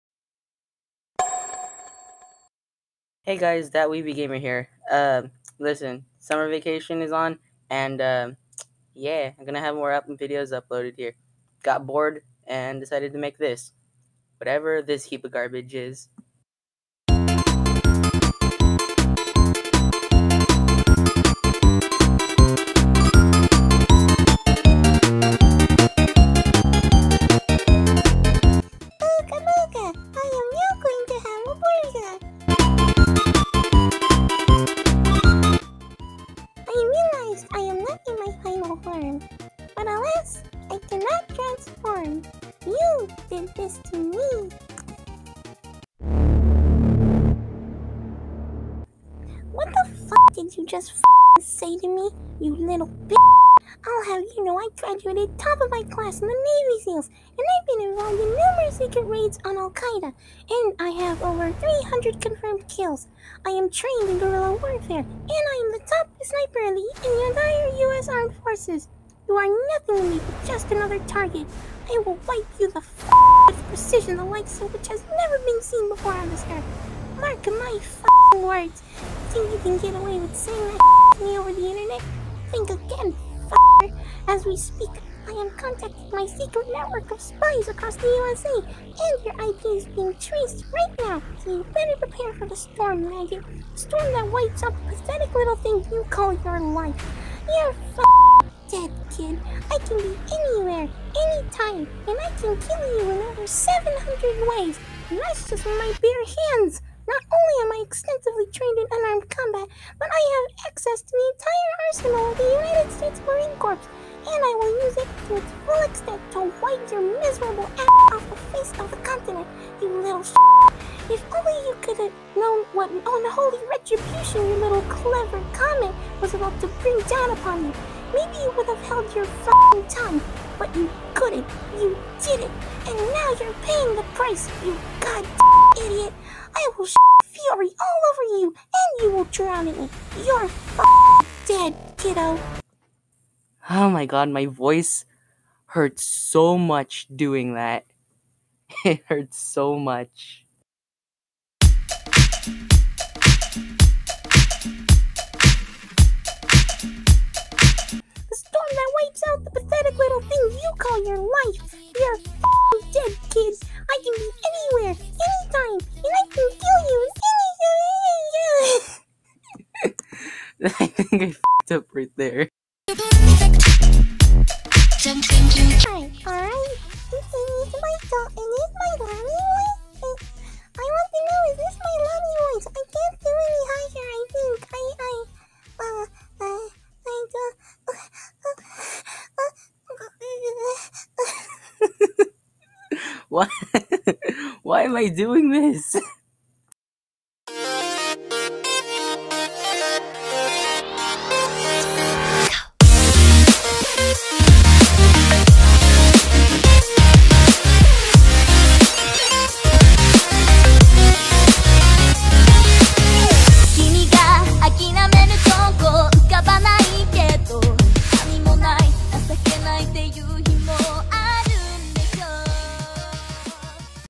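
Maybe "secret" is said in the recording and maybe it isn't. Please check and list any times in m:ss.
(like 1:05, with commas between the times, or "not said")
0:58, 1:26.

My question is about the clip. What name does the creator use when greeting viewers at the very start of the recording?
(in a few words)
Weeby Gamer.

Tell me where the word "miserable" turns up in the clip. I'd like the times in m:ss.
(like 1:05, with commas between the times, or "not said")
1:57.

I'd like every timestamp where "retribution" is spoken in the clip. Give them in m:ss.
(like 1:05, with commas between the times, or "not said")
2:03.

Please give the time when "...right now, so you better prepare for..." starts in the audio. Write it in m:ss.
1:30.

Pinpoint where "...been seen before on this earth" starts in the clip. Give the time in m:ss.
1:15.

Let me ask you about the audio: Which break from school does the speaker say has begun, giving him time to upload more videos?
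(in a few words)
Summer vacation.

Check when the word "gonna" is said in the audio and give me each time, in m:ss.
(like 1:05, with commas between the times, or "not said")
0:09.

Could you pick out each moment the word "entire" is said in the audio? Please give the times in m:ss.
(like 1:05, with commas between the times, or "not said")
1:07, 1:51.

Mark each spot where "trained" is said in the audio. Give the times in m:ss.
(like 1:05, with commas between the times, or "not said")
1:03, 1:48.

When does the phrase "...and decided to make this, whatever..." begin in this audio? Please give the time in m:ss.
0:12.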